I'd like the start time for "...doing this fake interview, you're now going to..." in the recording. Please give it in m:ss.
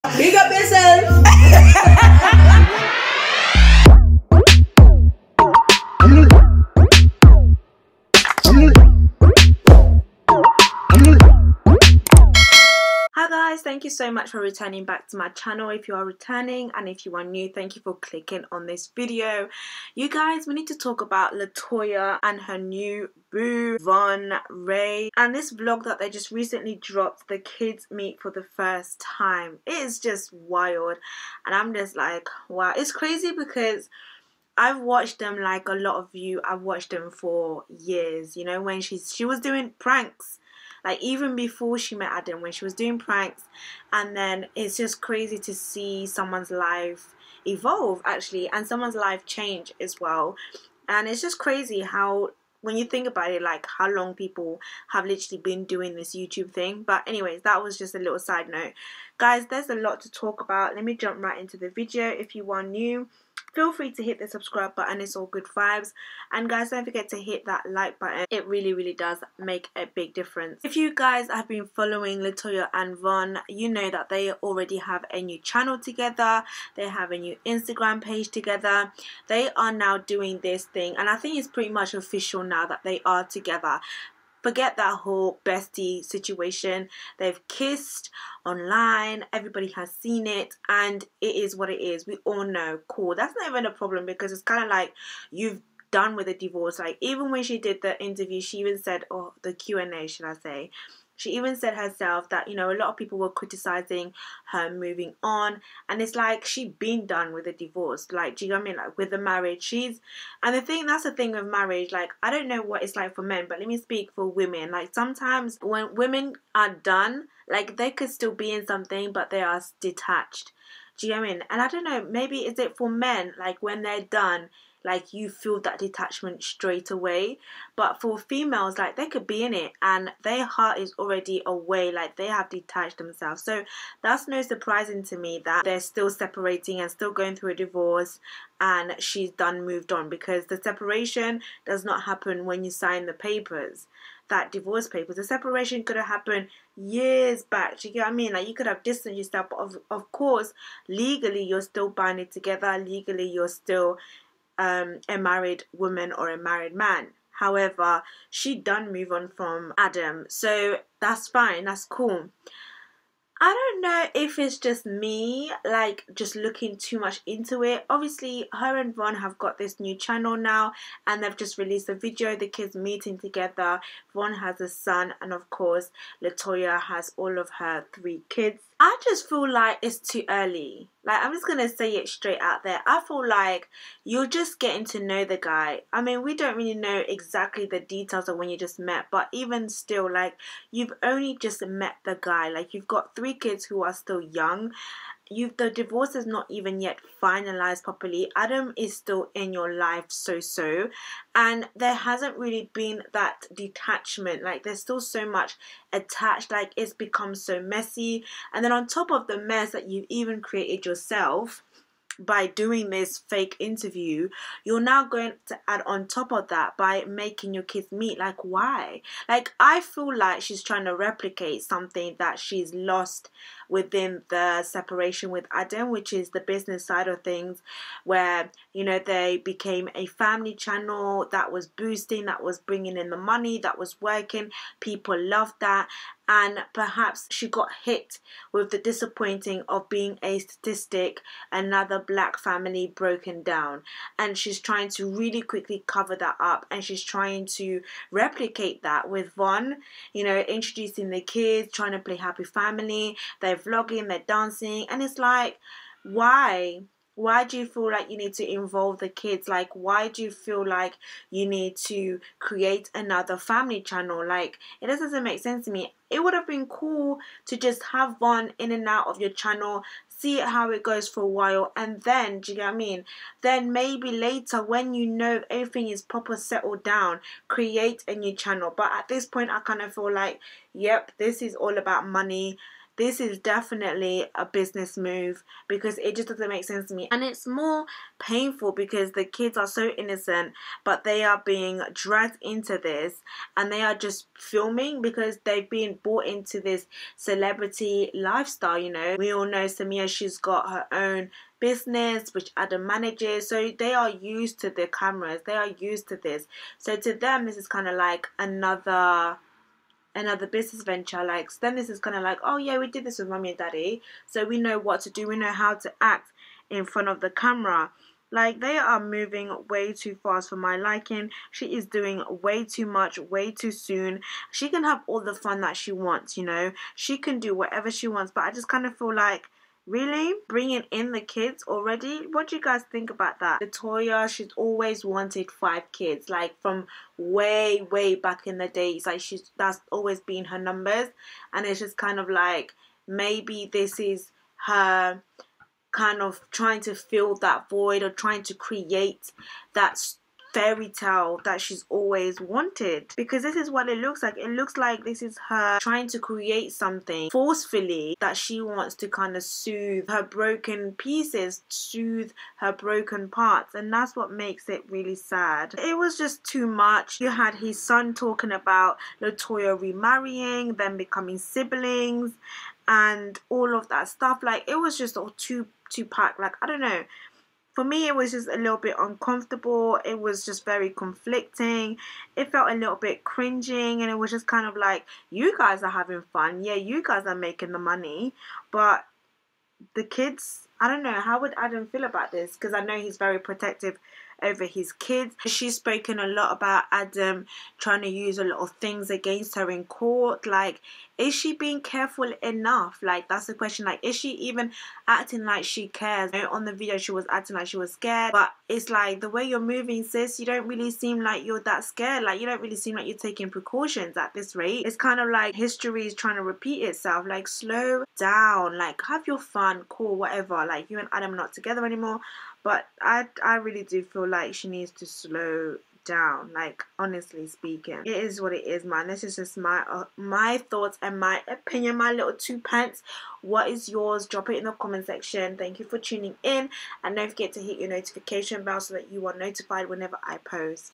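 3:32.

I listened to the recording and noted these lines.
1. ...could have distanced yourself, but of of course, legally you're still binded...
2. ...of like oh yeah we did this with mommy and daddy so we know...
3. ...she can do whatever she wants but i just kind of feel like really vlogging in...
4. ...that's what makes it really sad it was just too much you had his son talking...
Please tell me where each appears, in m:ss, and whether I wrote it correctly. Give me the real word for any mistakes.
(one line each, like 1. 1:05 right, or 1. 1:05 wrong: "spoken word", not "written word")
1. 2:28 right
2. 5:12 right
3. 5:26 wrong: "bringing", not "vlogging"
4. 6:03 right.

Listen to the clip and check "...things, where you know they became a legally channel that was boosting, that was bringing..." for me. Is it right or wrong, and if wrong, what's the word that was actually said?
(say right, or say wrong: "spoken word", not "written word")
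wrong: "family", not "legally".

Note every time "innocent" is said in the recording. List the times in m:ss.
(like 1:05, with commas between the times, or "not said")
4:49.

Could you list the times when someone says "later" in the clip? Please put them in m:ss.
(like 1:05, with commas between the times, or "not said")
4:34.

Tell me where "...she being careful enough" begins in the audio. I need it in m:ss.
6:41.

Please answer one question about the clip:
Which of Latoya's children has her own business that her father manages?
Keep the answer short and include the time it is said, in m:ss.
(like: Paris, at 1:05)
Samia, at 4:59.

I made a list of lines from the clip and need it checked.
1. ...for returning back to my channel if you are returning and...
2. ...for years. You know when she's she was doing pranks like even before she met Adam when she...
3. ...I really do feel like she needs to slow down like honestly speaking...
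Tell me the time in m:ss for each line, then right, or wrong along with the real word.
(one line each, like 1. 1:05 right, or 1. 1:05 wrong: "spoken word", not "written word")
1. 0:14 right
2. 0:37 right
3. 7:03 right.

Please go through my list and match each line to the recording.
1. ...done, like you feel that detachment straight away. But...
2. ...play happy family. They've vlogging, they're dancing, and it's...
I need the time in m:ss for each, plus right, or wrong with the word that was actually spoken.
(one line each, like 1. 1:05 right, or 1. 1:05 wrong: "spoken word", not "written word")
1. 2:04 right
2. 4:11 right.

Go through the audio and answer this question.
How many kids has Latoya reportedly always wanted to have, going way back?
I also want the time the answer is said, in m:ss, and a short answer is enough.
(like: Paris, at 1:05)
5, at 5:35.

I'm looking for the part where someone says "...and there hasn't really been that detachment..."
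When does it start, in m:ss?
3:21.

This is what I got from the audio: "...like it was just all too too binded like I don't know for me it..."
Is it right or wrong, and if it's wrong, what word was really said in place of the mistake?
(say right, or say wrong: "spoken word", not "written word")
wrong: "packed", not "binded".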